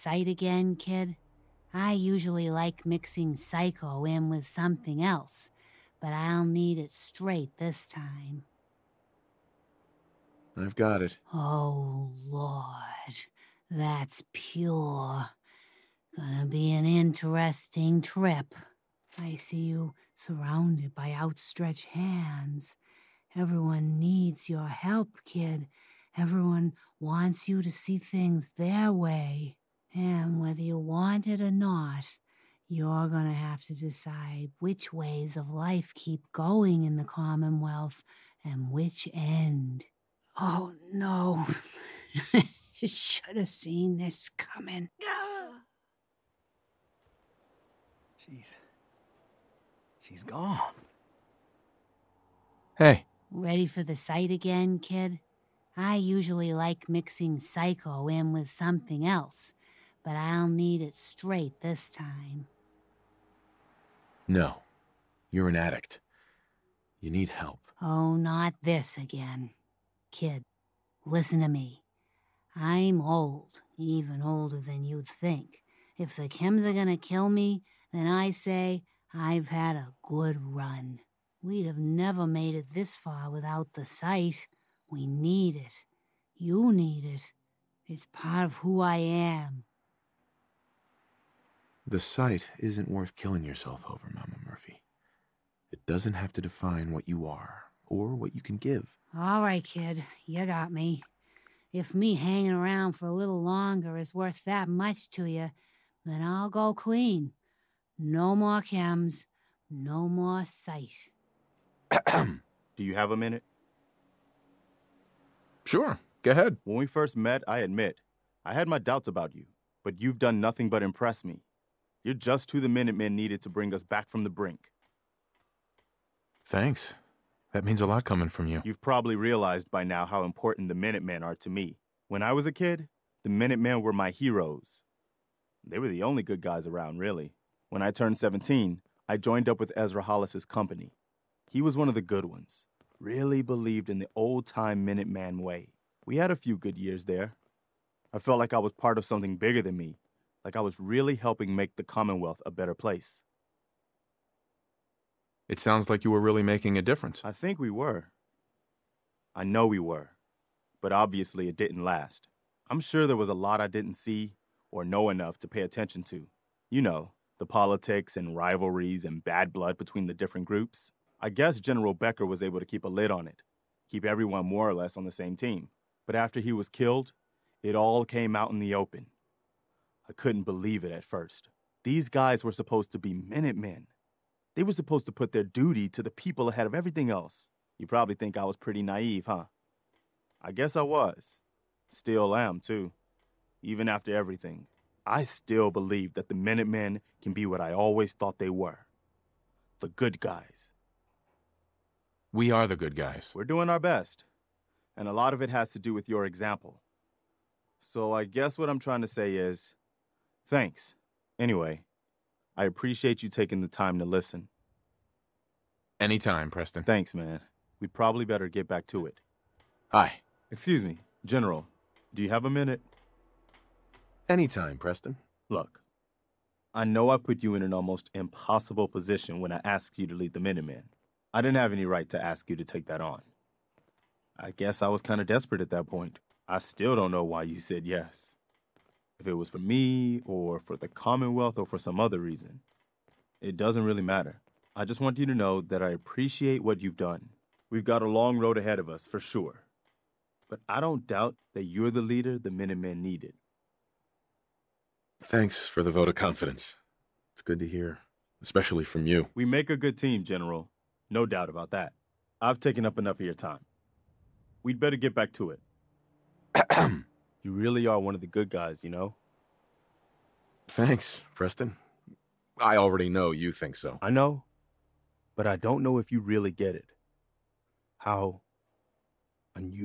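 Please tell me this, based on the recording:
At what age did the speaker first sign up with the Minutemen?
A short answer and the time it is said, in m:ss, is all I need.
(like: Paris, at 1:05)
17, at 2:18.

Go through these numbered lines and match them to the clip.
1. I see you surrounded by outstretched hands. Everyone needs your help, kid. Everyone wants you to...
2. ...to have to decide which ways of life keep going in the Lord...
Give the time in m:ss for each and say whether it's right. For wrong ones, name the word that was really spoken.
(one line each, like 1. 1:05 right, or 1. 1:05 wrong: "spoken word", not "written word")
1. 0:19 right
2. 0:33 wrong: "Commonwealth", not "Lord".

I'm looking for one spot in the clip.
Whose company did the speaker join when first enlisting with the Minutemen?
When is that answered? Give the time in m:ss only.
2:19.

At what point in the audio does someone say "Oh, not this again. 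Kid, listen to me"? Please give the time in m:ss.
1:07.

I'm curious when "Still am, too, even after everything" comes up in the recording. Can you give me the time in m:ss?
3:11.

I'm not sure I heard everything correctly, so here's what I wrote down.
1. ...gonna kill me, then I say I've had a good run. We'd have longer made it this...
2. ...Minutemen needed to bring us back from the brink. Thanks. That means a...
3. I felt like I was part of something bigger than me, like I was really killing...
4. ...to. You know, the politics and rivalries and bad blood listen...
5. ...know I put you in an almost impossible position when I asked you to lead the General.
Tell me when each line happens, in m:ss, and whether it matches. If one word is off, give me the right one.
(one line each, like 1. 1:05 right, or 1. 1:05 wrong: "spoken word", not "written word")
1. 1:16 wrong: "never", not "longer"
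2. 2:02 right
3. 2:28 wrong: "helping", not "killing"
4. 2:46 wrong: "between", not "listen"
5. 3:46 wrong: "Minutemen", not "General".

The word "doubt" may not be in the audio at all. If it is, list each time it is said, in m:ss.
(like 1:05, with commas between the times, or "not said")
1:58, 4:11, 4:21.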